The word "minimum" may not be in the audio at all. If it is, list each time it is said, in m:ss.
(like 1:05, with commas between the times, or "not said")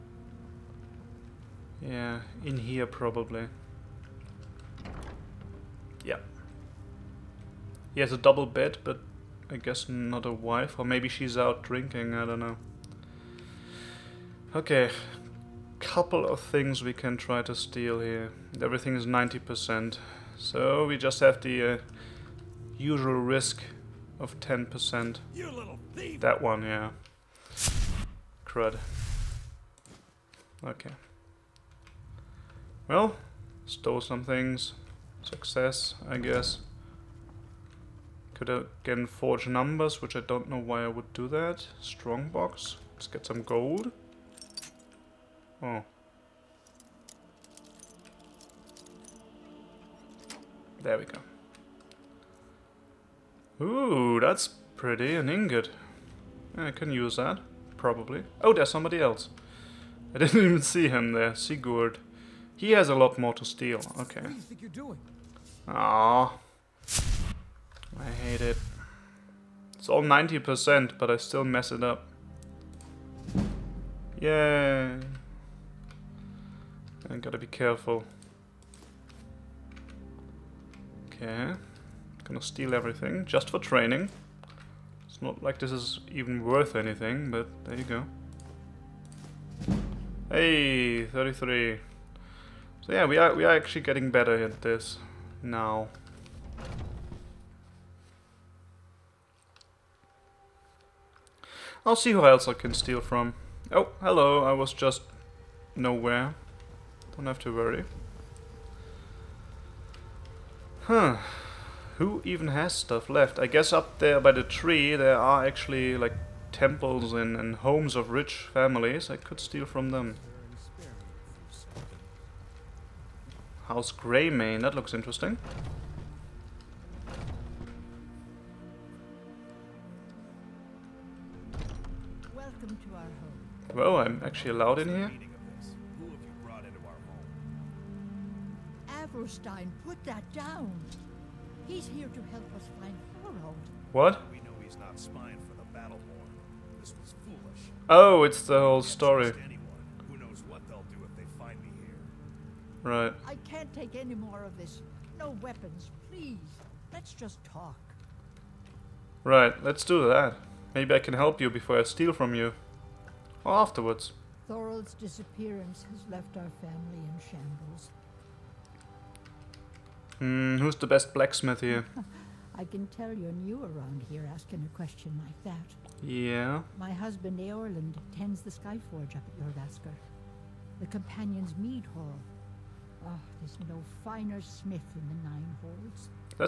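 not said.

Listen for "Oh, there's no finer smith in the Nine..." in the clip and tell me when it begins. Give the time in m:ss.
3:03.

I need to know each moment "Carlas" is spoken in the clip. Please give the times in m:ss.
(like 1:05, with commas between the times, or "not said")
not said.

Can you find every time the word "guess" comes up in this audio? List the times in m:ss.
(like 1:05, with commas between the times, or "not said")
0:09, 0:36, 1:53.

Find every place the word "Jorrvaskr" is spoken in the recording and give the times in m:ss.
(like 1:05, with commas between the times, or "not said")
2:59.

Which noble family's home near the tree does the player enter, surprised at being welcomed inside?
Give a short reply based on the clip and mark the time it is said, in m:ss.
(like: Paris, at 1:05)
House Greymane, at 2:03.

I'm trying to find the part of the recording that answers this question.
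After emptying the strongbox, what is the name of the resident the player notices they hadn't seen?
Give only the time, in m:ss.
1:01.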